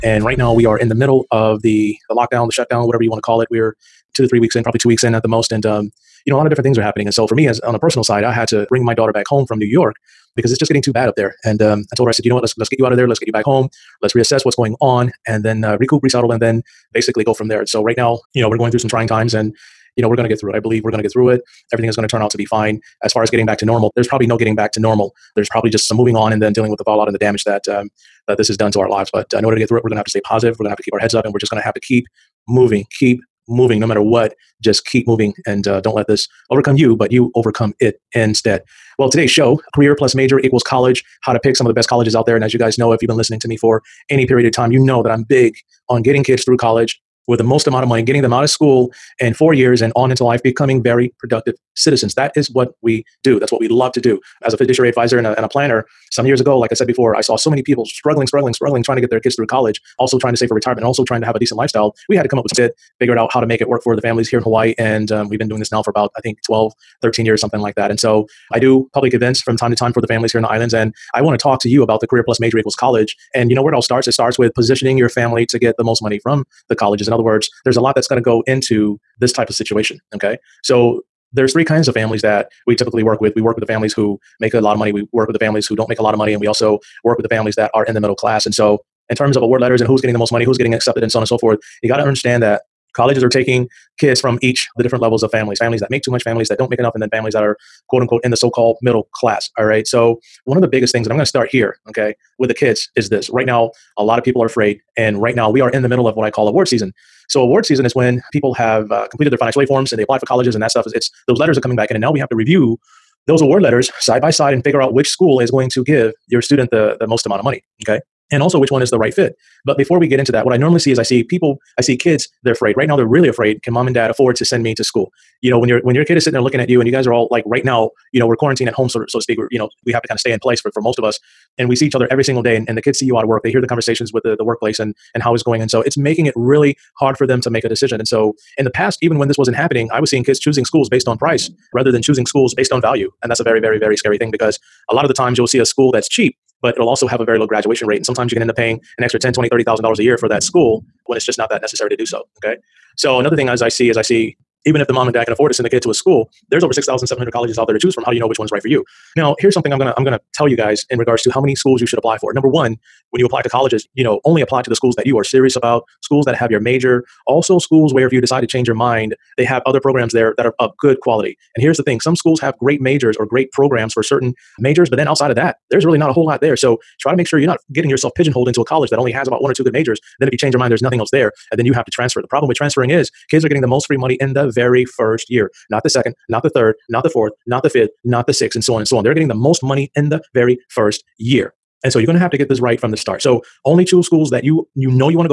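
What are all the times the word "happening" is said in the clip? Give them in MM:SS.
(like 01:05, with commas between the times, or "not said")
00:06, 02:19.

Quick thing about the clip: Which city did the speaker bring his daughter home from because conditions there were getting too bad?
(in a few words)
New York.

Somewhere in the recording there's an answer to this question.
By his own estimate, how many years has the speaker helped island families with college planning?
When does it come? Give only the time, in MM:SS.
01:06.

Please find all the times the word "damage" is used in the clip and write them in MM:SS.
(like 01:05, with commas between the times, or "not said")
00:27.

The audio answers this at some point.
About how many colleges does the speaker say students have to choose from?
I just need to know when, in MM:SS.
02:36.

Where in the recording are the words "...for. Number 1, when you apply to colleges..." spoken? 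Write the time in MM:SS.
02:42.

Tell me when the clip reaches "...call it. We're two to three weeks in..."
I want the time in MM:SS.
00:03.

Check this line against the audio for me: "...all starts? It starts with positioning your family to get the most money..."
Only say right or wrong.
right.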